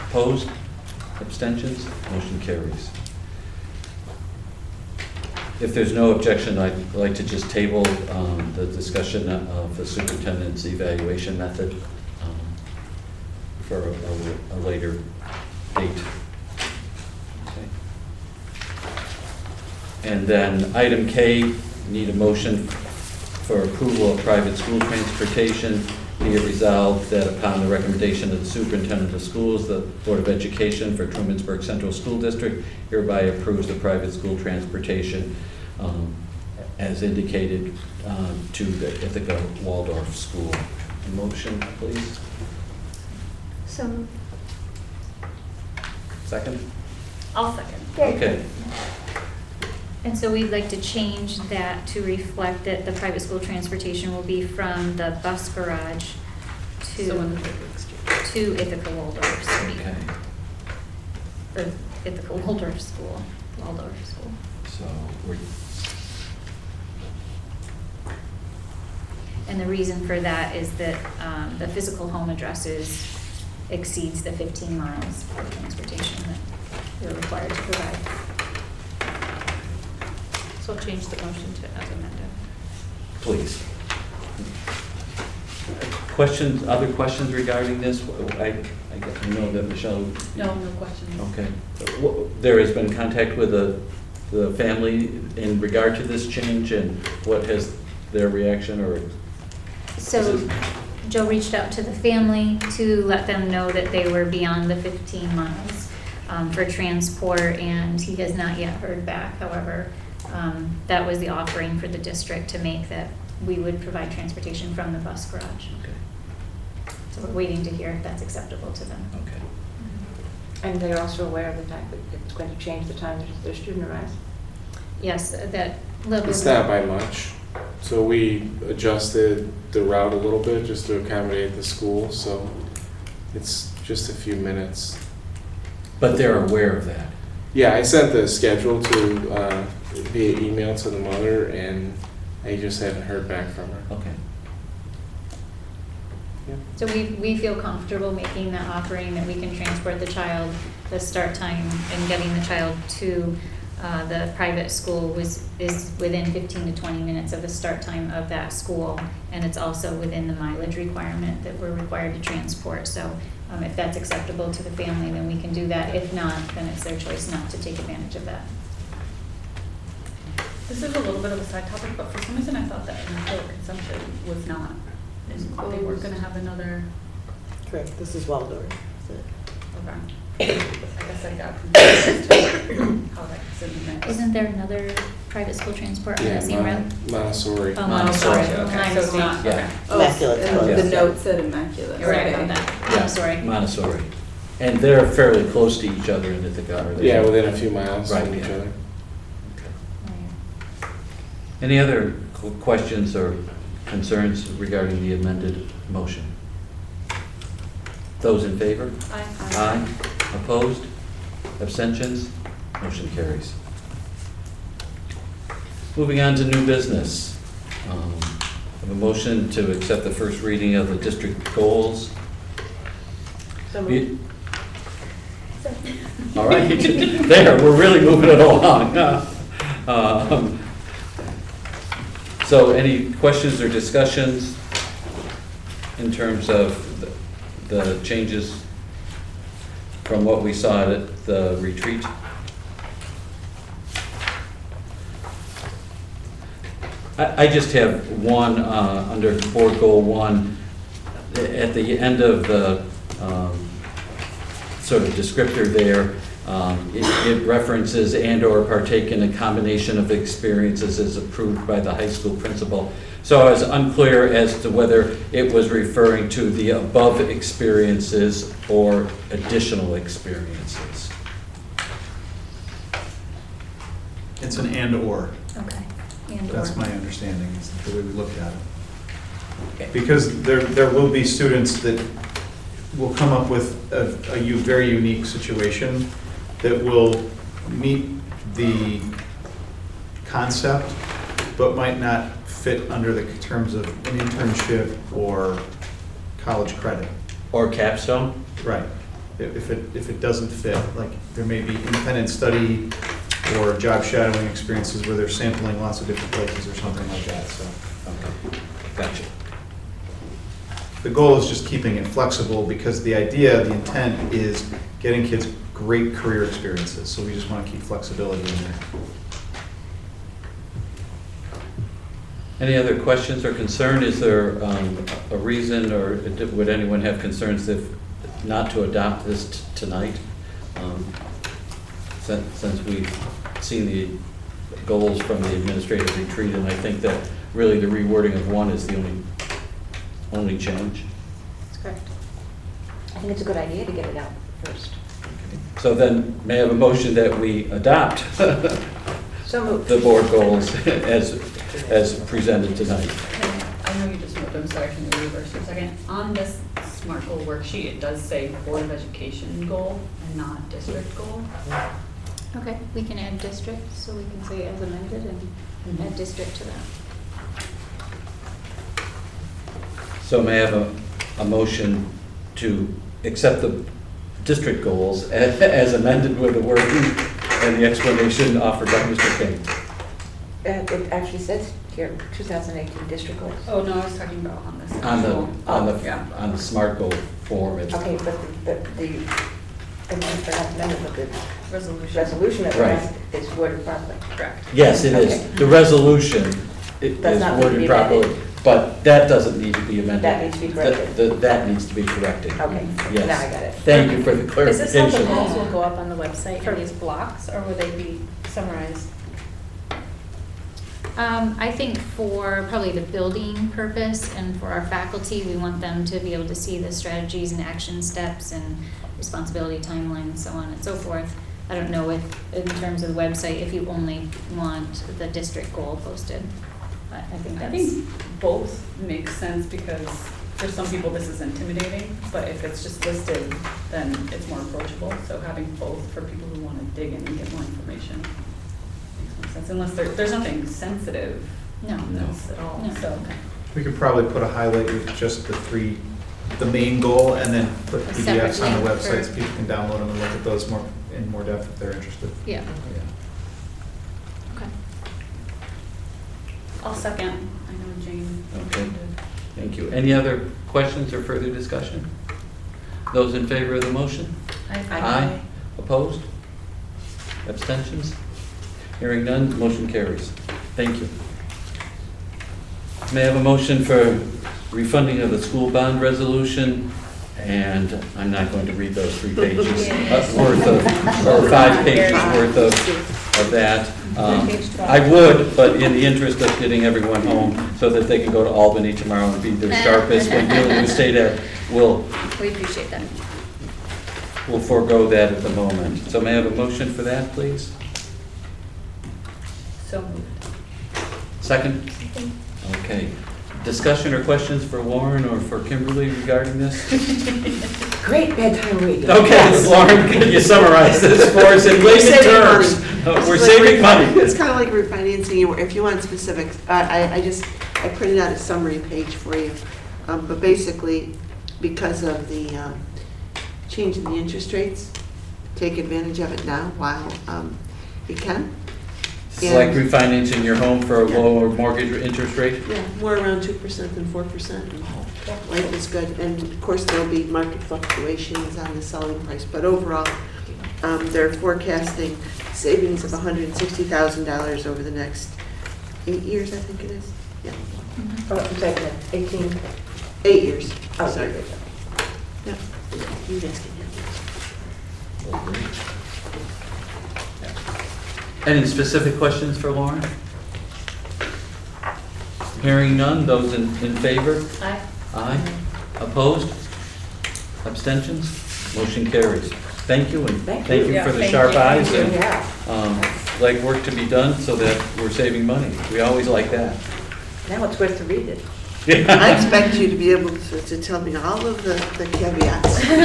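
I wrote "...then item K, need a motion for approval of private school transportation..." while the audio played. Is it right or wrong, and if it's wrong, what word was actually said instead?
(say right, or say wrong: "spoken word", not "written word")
right.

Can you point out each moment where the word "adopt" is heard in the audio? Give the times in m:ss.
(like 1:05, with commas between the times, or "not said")
5:28, 5:47.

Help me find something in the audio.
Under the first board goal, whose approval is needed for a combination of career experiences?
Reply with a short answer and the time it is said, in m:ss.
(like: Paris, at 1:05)
the high school principal, at 4:21.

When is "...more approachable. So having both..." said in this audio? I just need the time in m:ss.
7:14.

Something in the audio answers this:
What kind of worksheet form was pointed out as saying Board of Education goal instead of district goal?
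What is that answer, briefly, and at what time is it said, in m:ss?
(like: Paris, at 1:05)
SMART goal worksheet, at 5:56.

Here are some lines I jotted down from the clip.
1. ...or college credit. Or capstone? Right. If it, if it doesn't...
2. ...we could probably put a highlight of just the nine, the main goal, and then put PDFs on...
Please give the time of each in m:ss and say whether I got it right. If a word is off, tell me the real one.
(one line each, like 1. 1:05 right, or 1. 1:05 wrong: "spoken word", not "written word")
1. 4:55 right
2. 7:23 wrong: "three", not "nine".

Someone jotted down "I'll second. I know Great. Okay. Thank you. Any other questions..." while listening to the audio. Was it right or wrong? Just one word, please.
wrong.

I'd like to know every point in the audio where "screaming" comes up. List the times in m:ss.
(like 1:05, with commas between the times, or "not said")
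not said.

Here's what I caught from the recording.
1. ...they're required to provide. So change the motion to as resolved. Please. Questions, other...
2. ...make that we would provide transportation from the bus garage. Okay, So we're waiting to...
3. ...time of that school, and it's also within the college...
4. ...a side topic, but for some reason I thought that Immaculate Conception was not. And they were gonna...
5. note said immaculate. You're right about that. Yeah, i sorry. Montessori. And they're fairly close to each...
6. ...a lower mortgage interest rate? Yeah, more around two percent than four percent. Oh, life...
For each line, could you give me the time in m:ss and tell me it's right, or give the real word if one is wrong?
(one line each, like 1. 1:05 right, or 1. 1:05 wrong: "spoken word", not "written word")
1. 1:16 wrong: "amended", not "resolved"
2. 1:52 right
3. 2:37 wrong: "mileage", not "college"
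4. 2:51 right
5. 3:10 right
6. 8:51 right.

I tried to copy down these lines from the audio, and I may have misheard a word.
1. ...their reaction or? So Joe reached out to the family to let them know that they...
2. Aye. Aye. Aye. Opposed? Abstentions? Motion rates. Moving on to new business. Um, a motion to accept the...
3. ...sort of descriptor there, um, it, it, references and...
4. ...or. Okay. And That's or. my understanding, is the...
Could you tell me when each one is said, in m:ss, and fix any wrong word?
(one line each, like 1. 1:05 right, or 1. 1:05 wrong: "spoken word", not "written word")
1. 1:38 right
2. 3:29 wrong: "carries", not "rates"
3. 4:14 right
4. 4:34 right.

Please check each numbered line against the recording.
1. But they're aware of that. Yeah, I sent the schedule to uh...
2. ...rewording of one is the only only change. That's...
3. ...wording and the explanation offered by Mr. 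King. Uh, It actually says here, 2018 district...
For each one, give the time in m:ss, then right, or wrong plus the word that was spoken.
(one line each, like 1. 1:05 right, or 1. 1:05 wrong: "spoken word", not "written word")
1. 2:15 right
2. 5:37 right
3. 6:16 right.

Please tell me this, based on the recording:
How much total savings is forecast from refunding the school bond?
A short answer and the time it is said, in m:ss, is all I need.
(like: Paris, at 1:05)
$160,000, at 9:03.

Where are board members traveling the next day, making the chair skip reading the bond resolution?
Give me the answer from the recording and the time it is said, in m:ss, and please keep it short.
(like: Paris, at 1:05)
Albany, at 8:08.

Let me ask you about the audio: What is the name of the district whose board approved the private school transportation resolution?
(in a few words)
Trumansburg Central School District.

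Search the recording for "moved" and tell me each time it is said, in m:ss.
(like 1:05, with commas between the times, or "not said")
0:43, 3:43, 5:49, 5:54, 8:20.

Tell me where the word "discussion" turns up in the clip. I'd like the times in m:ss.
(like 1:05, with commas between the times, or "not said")
0:08, 3:53, 7:41, 8:23.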